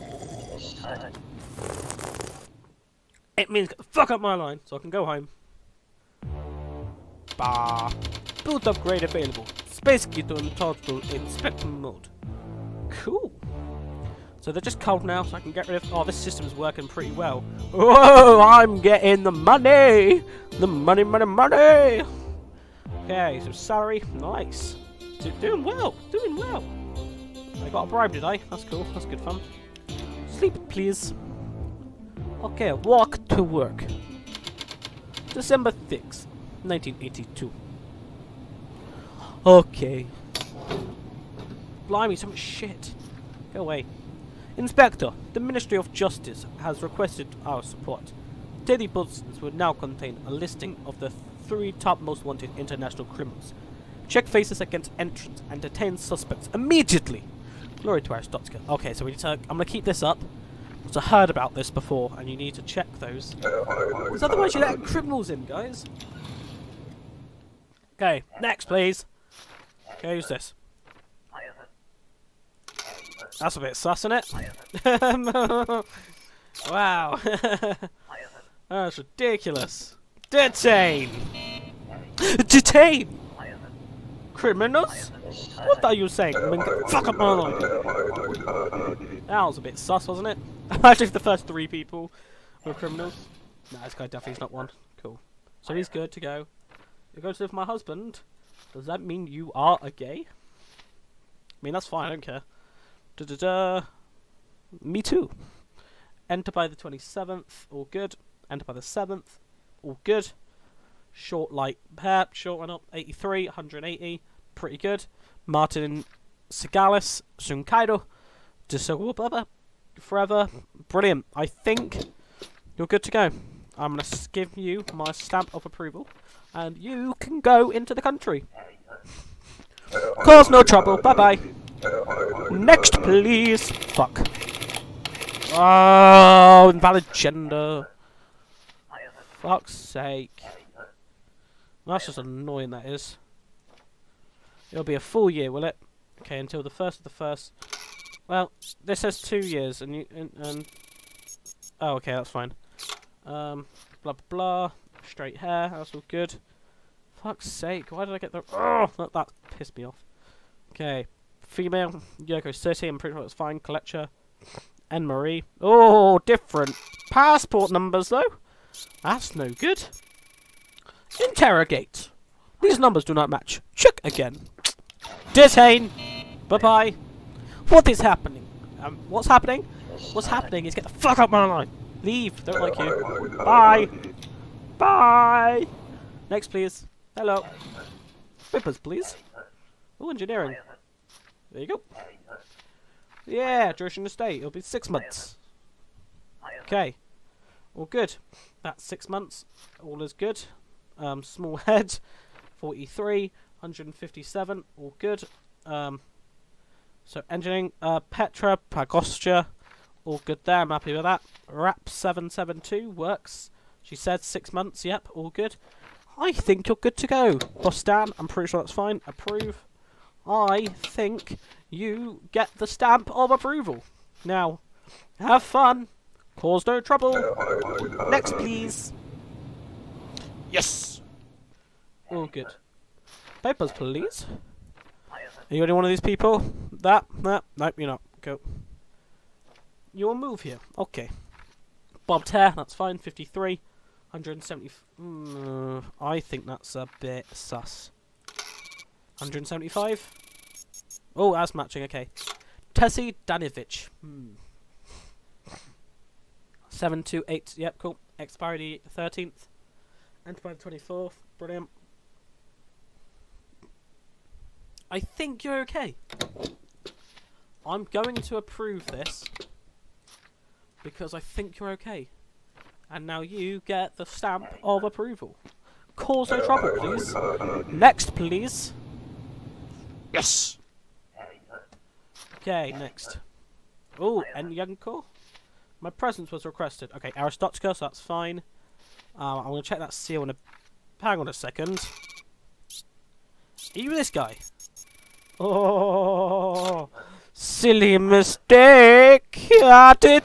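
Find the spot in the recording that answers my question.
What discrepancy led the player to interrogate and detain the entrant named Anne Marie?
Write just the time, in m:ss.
2:46.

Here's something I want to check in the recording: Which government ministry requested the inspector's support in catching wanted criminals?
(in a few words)
Ministry of Justice.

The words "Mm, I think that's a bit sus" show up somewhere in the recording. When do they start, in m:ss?
4:05.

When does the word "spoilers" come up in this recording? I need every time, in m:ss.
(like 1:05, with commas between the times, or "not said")
not said.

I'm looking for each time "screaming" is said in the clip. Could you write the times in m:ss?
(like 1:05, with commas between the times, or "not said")
not said.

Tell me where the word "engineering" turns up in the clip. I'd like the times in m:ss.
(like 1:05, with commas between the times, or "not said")
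3:10, 3:27.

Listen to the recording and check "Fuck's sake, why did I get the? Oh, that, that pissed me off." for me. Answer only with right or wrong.
right.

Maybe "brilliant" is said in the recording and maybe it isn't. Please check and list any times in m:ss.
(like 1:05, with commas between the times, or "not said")
2:00, 4:21.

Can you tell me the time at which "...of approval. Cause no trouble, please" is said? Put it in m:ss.
4:34.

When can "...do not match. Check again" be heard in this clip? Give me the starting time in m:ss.
2:53.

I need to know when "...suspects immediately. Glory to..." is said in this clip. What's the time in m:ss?
0:55.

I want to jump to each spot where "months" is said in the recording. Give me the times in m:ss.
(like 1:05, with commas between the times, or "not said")
3:14, 3:19, 3:34.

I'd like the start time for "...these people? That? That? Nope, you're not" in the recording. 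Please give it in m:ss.
3:55.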